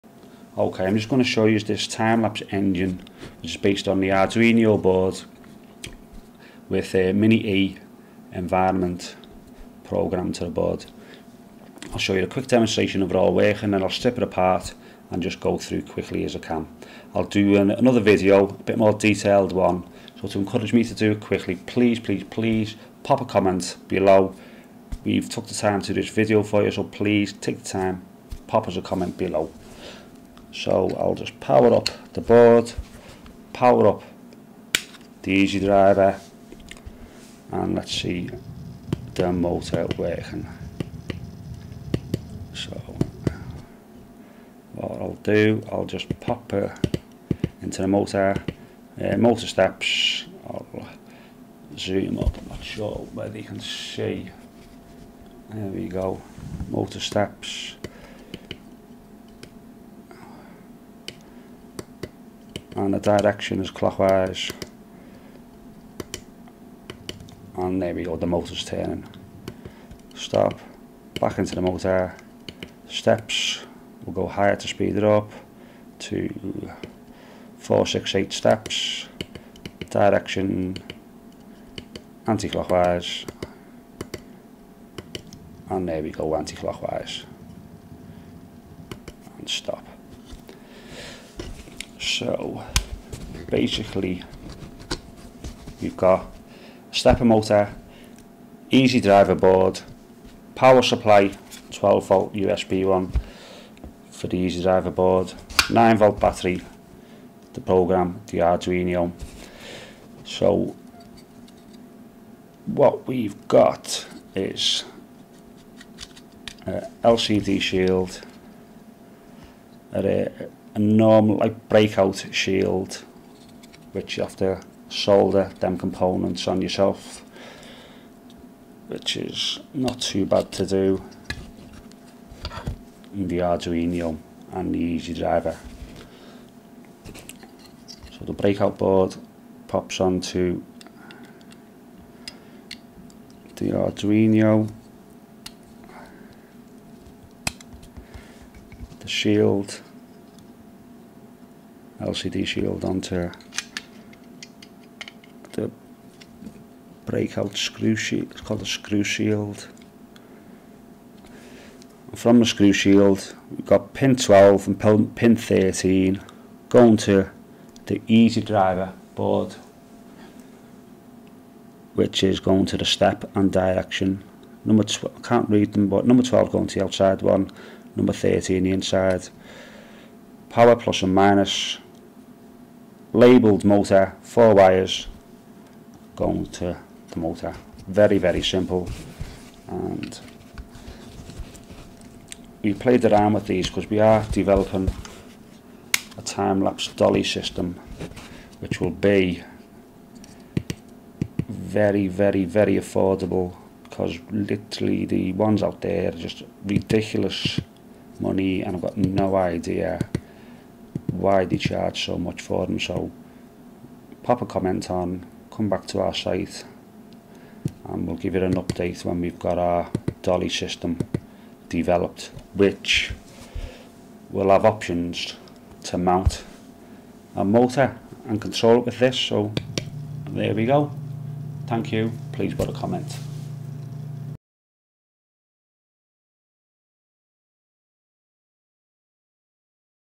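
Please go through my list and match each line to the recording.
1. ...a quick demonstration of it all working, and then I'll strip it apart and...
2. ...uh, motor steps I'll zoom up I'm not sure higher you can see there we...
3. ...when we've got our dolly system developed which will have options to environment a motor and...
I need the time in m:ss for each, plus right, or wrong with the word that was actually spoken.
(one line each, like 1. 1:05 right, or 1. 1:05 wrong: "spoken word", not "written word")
1. 0:12 right
2. 0:49 wrong: "whether", not "higher"
3. 3:39 wrong: "mount", not "environment".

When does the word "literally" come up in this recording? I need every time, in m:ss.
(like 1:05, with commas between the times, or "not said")
3:24.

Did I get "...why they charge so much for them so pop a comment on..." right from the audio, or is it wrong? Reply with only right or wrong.
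right.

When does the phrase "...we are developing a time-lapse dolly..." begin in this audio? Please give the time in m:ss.
3:13.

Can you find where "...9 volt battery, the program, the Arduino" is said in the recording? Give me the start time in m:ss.
1:45.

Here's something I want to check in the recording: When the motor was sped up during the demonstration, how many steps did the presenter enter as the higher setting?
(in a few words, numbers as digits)
468.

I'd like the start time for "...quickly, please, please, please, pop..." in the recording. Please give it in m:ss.
0:21.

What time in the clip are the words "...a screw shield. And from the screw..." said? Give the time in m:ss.
2:38.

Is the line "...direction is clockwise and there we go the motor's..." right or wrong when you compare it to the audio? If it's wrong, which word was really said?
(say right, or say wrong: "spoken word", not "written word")
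right.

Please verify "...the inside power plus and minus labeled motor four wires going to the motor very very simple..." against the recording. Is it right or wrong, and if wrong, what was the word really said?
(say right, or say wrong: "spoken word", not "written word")
right.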